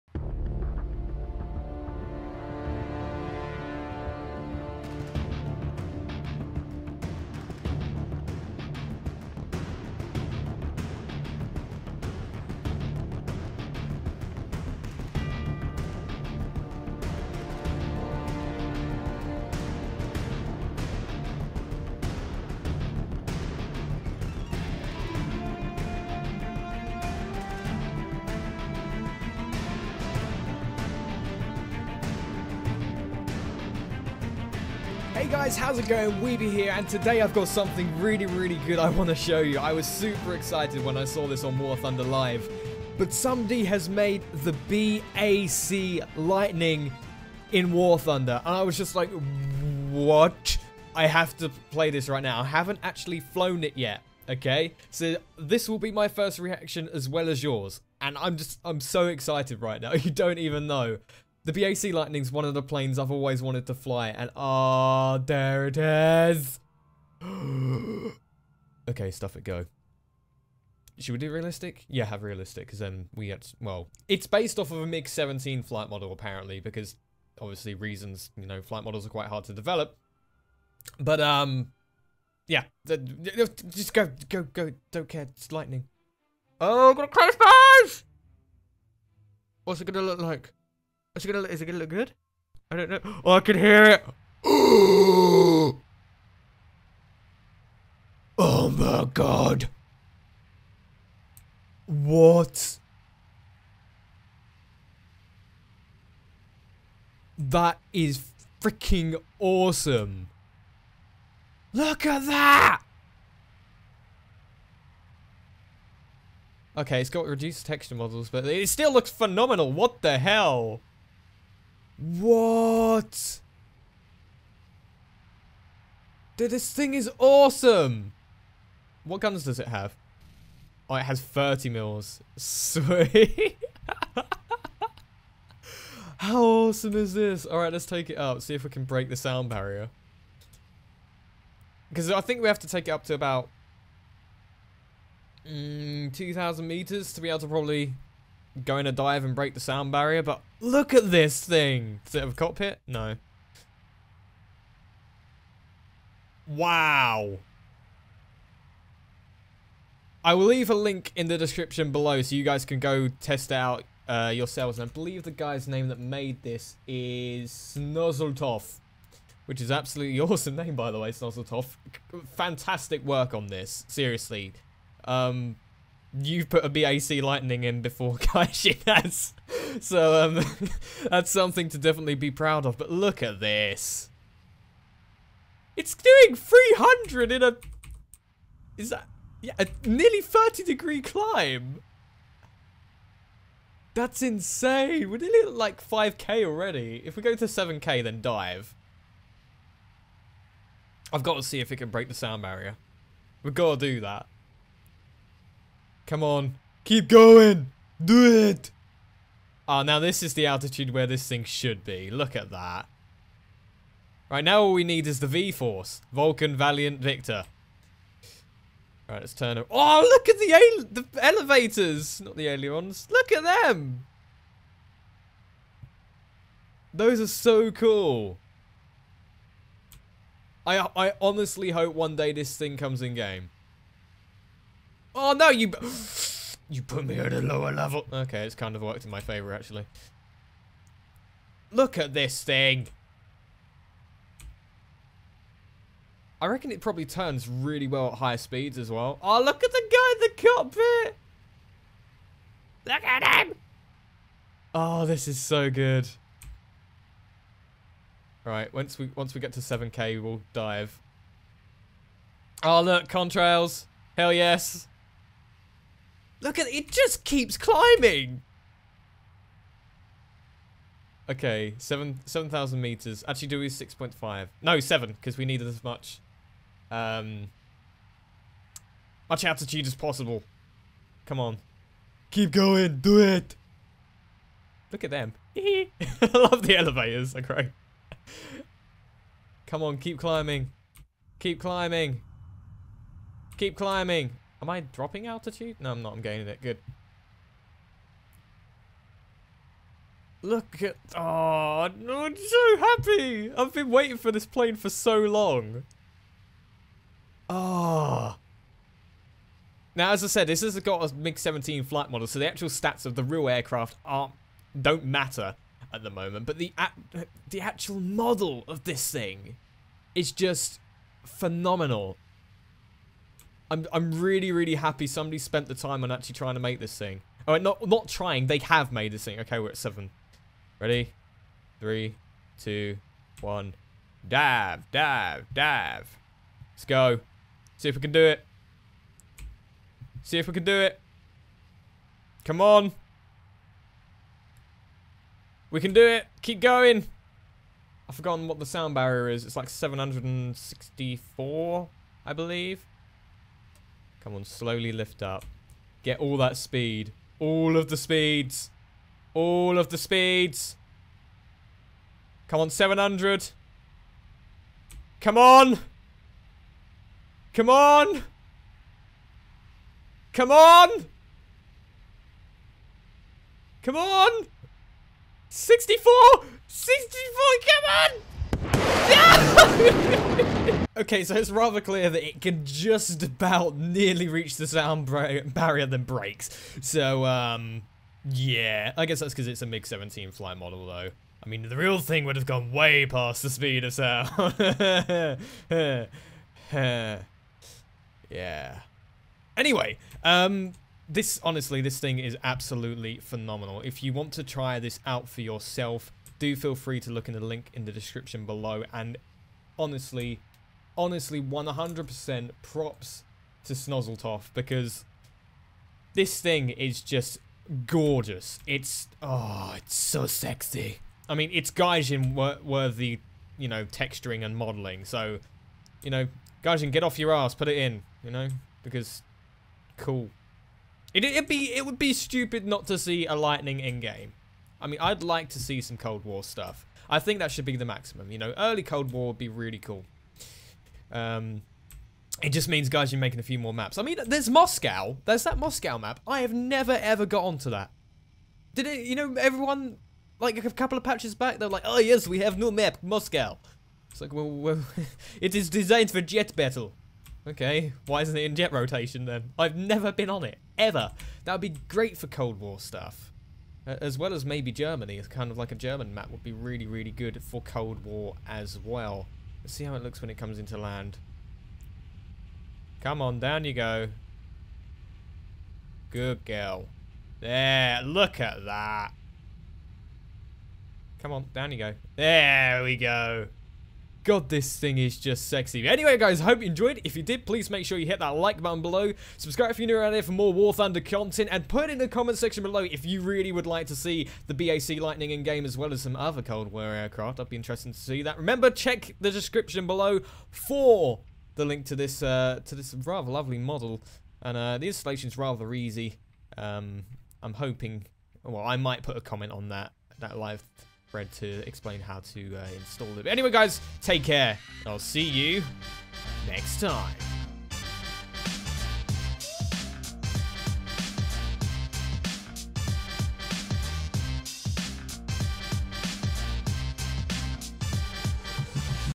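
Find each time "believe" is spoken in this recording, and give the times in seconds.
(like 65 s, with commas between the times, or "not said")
164 s, 352 s.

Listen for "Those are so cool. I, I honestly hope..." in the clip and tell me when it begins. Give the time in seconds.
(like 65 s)
226 s.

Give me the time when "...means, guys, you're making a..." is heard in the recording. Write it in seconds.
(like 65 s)
442 s.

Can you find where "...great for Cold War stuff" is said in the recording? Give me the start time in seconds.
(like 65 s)
461 s.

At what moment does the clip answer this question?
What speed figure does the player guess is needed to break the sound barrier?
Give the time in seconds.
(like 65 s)
349 s.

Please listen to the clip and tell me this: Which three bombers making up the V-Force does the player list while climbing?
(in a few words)
Vulcan, Valiant, Victor.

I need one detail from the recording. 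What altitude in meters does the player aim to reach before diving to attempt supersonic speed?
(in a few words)
7000.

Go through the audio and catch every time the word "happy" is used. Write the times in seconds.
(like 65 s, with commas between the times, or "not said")
302 s, 324 s.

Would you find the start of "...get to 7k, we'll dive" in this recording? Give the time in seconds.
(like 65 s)
259 s.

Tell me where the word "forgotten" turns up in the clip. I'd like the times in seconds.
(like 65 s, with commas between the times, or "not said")
348 s.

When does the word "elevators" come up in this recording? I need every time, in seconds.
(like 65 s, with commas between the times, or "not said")
221 s, 286 s.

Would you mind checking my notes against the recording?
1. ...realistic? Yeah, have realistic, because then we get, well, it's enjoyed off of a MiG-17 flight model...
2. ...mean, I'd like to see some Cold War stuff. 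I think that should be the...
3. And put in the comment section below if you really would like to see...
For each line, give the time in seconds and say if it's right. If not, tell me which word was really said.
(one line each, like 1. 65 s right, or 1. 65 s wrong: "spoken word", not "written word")
1. 71 s wrong: "based", not "enjoyed"
2. 434 s right
3. 491 s right.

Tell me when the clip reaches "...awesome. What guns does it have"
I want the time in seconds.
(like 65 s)
127 s.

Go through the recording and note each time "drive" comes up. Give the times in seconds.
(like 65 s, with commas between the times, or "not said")
not said.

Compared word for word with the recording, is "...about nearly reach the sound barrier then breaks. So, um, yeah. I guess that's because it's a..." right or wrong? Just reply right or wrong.
right.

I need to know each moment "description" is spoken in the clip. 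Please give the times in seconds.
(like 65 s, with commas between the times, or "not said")
161 s, 407 s, 499 s.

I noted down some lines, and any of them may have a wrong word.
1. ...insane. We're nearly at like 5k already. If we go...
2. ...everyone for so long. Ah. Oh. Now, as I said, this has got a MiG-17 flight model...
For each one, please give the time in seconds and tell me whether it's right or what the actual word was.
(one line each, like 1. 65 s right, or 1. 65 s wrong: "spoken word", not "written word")
1. 194 s right
2. 304 s wrong: "plane", not "everyone".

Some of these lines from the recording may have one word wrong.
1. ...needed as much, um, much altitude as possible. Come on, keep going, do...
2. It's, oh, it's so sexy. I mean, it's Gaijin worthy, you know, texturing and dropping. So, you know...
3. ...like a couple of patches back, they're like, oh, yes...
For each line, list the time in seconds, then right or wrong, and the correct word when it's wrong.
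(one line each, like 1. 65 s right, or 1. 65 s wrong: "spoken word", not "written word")
1. 275 s right
2. 418 s wrong: "modeling", not "dropping"
3. 450 s right.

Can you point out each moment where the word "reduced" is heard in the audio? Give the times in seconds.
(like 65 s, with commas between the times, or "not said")
117 s.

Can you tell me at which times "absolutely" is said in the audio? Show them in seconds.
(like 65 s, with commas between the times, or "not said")
169 s, 402 s.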